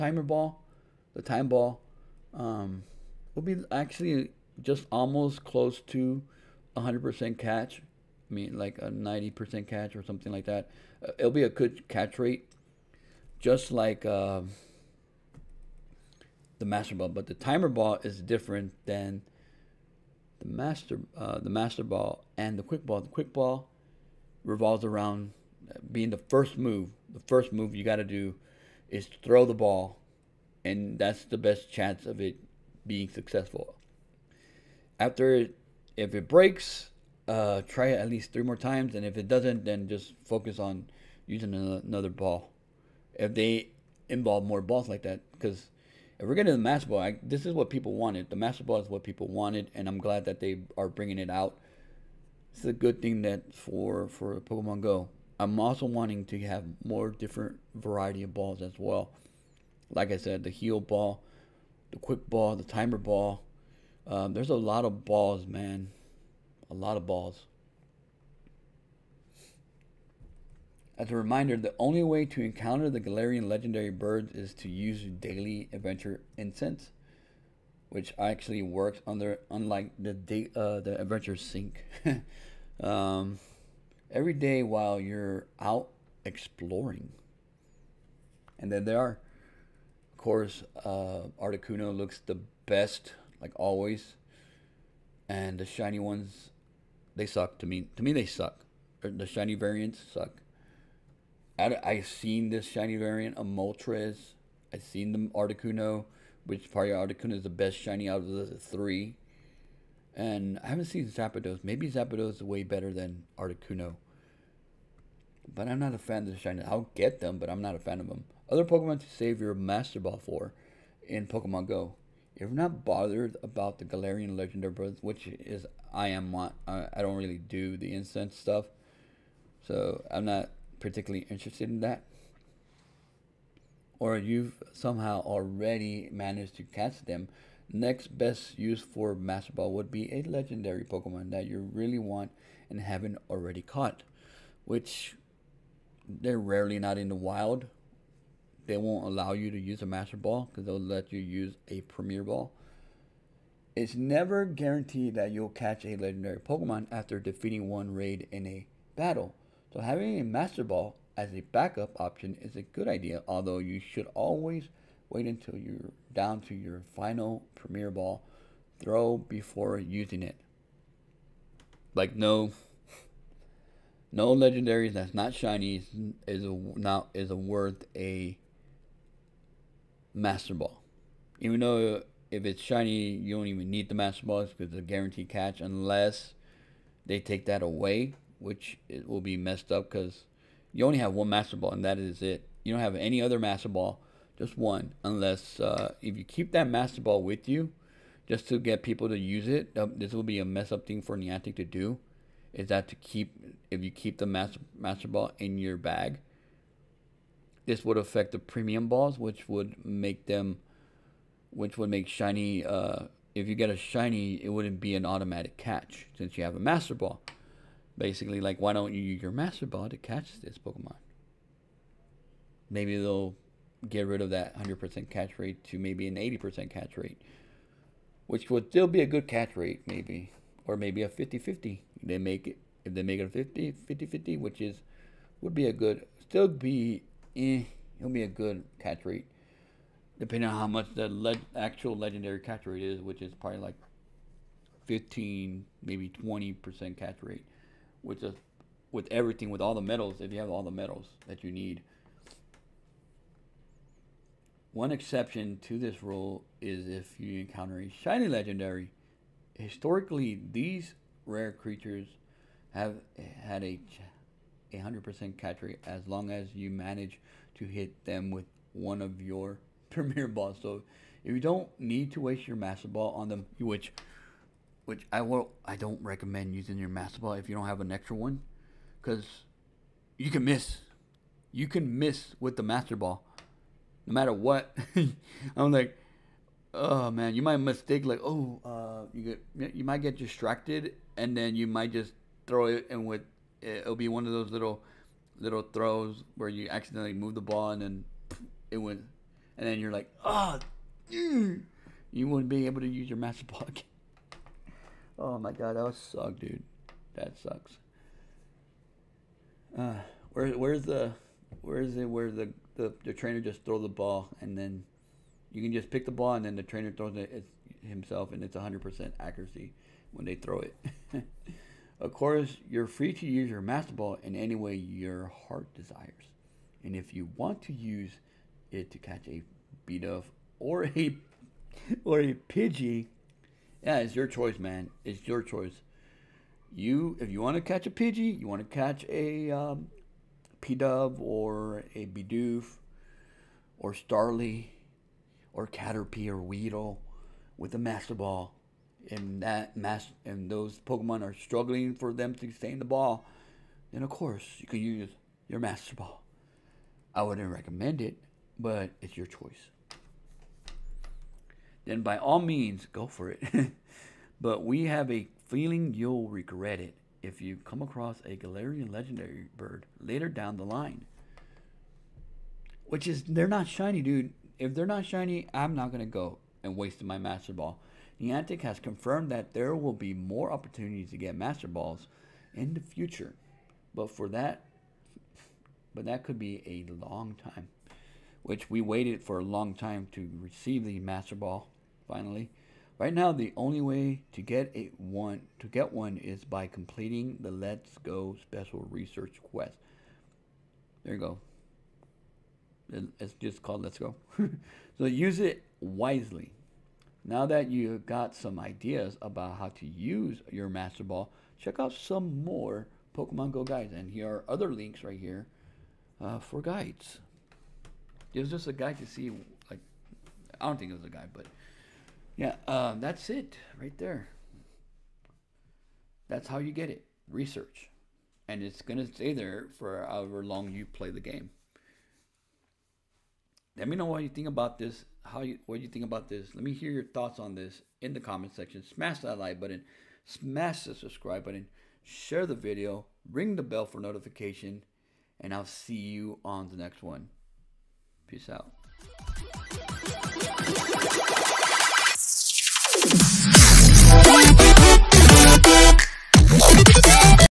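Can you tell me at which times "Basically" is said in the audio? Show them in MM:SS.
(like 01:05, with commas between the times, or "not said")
03:37.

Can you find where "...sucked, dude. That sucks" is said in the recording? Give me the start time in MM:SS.
05:05.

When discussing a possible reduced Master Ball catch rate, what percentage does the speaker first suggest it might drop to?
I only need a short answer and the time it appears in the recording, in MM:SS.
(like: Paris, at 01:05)
80%, at 03:46.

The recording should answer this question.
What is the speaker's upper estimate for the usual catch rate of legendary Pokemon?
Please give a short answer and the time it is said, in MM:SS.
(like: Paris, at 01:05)
20%, at 04:05.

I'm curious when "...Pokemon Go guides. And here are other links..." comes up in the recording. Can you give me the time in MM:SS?
06:53.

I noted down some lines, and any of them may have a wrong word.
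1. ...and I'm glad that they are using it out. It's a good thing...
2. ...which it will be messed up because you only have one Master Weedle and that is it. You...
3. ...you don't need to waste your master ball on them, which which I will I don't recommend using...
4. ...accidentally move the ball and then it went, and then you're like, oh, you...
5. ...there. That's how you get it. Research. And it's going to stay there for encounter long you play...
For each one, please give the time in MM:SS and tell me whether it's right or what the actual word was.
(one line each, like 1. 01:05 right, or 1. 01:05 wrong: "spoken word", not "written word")
1. 00:49 wrong: "bringing", not "using"
2. 03:08 wrong: "Ball", not "Weedle"
3. 04:31 right
4. 04:56 right
5. 07:03 wrong: "however", not "encounter".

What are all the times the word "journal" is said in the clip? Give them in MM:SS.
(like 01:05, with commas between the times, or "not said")
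not said.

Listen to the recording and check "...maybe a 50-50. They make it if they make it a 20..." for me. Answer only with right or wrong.
wrong.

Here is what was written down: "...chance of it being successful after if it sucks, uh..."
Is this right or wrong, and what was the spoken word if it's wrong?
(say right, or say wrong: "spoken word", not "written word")
wrong: "breaks", not "sucks".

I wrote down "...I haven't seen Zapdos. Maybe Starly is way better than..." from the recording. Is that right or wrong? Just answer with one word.
wrong.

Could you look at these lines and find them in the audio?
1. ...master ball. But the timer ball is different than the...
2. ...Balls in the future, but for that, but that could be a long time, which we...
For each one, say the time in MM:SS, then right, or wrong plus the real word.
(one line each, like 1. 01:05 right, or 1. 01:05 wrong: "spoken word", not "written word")
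1. 00:16 right
2. 06:21 right.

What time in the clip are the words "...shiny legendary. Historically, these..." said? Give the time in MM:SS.
04:17.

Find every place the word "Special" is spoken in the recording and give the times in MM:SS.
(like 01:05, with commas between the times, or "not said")
06:38.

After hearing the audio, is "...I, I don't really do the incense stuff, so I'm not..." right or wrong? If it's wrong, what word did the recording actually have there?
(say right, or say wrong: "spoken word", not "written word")
right.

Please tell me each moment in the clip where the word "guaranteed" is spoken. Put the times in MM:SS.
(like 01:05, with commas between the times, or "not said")
02:34, 03:04.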